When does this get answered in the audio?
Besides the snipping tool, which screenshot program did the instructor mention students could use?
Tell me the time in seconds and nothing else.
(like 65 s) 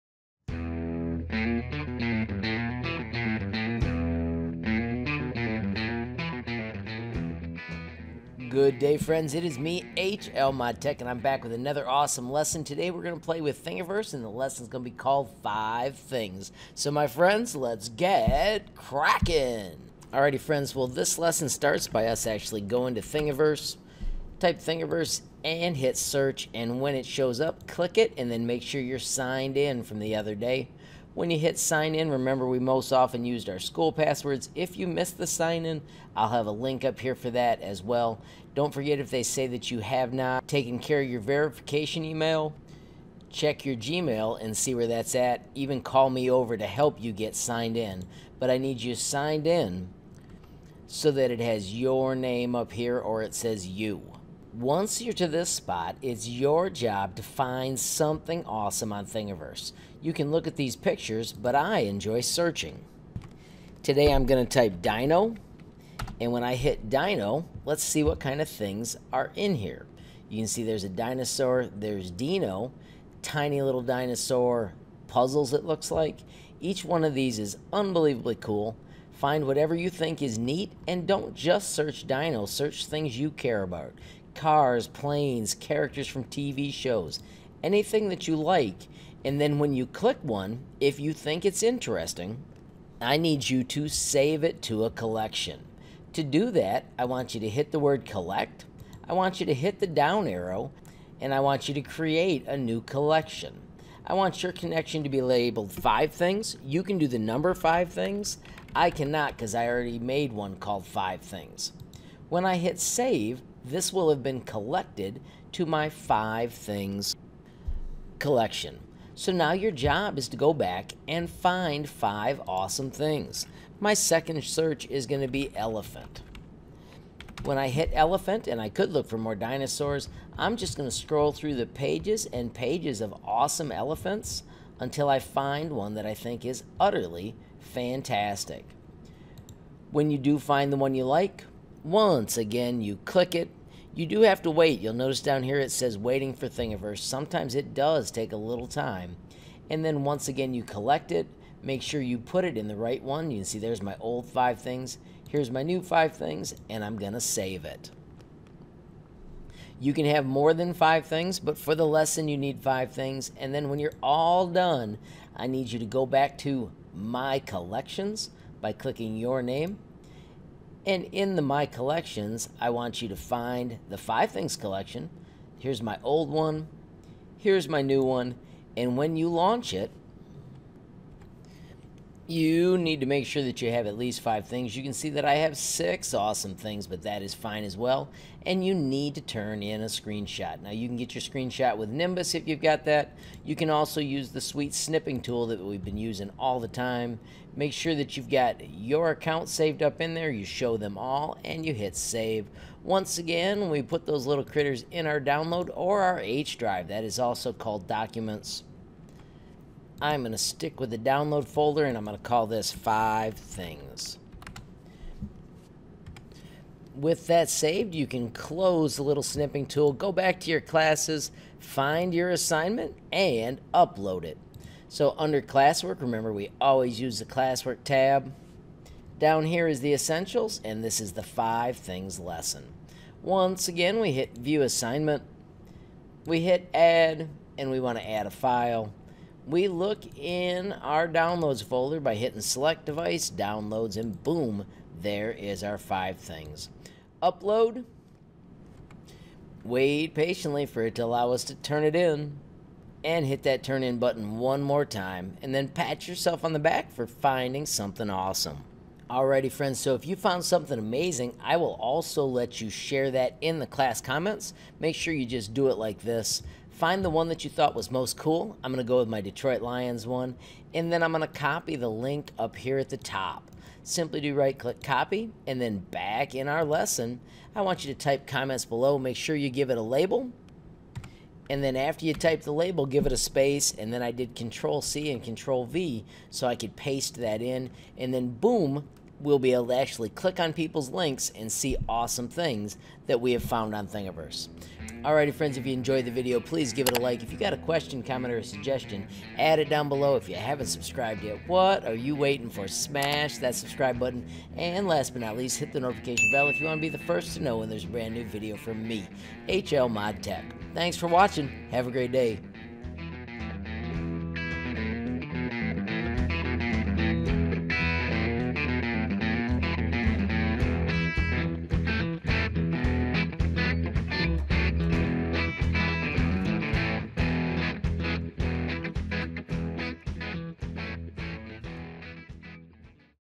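191 s.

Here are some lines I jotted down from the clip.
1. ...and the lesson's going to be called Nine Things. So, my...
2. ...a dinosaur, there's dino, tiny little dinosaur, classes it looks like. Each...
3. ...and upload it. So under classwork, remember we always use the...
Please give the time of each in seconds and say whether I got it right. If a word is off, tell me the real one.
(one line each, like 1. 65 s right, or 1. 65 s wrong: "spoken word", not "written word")
1. 14 s wrong: "Five", not "Nine"
2. 70 s wrong: "puzzles", not "classes"
3. 223 s right.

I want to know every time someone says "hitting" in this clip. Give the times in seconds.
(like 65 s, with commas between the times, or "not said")
242 s.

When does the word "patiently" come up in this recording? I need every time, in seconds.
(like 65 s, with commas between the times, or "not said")
250 s.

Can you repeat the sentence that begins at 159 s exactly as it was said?
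You can have more than five things, but for the lesson, you need five things.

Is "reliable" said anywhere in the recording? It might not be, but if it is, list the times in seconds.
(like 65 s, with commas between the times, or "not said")
not said.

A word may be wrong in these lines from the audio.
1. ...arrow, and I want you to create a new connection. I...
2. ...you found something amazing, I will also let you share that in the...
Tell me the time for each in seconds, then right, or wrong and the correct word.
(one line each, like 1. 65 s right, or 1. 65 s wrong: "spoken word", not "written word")
1. 100 s wrong: "collection", not "connection"
2. 260 s right.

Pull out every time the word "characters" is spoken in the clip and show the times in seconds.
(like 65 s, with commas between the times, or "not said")
85 s.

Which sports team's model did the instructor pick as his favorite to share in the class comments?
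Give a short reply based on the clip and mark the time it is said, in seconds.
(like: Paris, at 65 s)
Detroit Lions, at 269 s.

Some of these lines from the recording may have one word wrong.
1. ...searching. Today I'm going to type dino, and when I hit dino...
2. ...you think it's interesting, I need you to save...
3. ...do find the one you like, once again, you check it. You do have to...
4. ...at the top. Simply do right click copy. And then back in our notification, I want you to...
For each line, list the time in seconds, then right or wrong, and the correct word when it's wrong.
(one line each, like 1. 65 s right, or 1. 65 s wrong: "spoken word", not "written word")
1. 62 s right
2. 90 s right
3. 140 s wrong: "click", not "check"
4. 272 s wrong: "lesson", not "notification".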